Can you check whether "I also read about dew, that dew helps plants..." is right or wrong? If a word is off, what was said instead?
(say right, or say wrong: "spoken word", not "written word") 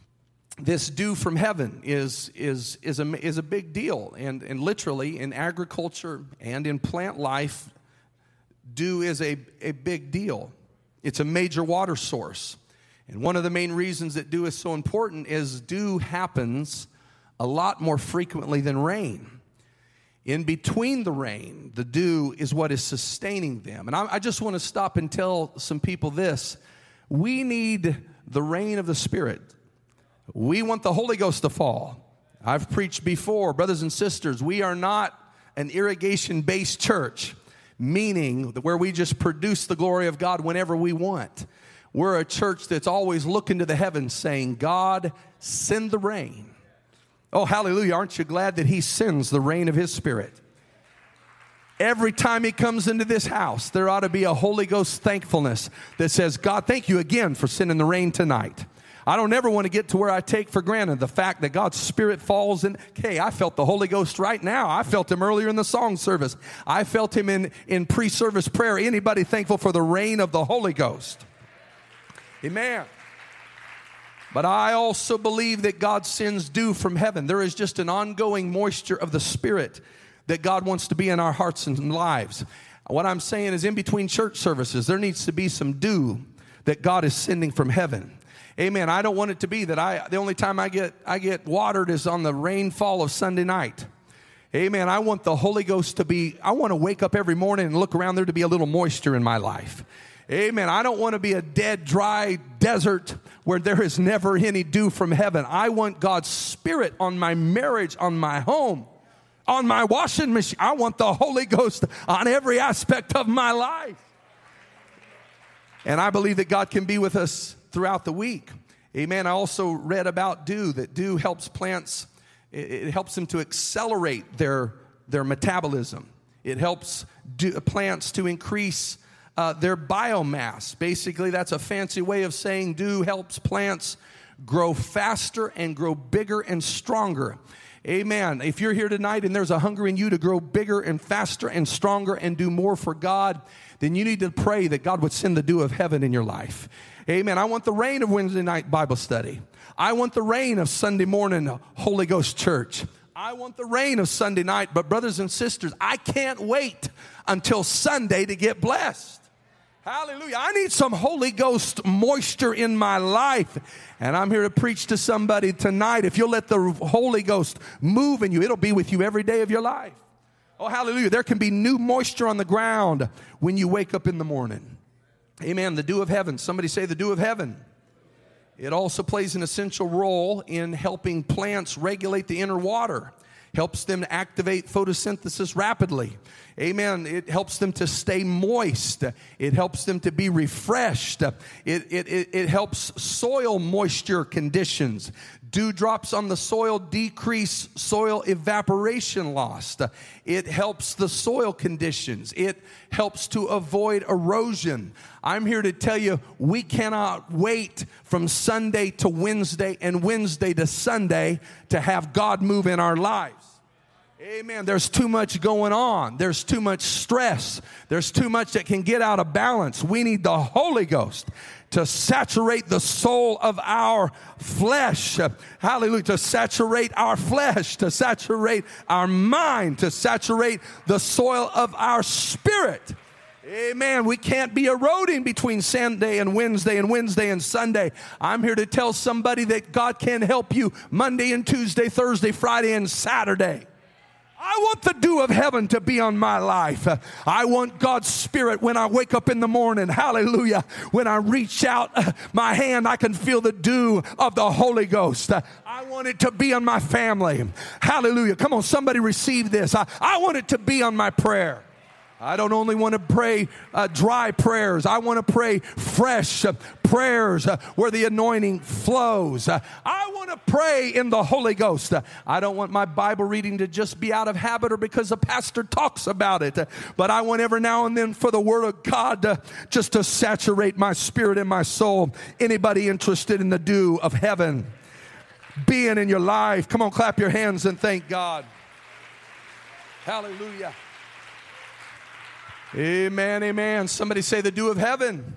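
right.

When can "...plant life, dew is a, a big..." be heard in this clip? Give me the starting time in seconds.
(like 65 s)
6 s.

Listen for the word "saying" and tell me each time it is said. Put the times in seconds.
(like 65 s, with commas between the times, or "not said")
44 s, 83 s, 132 s.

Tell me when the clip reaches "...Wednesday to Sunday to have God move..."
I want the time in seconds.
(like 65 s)
210 s.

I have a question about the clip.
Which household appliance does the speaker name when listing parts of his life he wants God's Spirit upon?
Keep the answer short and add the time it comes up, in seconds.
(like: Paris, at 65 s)
Washing machine, at 109 s.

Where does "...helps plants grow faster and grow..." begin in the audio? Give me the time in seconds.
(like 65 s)
133 s.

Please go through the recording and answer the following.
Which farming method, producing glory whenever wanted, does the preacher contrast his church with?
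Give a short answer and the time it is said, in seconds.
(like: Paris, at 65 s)
Irrigation, at 35 s.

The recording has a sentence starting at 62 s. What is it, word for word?
Okay, I felt the Holy Ghost right now.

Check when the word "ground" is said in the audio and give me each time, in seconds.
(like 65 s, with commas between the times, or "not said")
172 s.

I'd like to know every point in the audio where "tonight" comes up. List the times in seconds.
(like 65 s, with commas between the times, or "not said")
58 s, 138 s, 165 s.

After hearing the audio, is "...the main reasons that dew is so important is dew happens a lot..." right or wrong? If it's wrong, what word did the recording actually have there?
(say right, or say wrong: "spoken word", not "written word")
right.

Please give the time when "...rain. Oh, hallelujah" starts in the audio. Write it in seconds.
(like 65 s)
45 s.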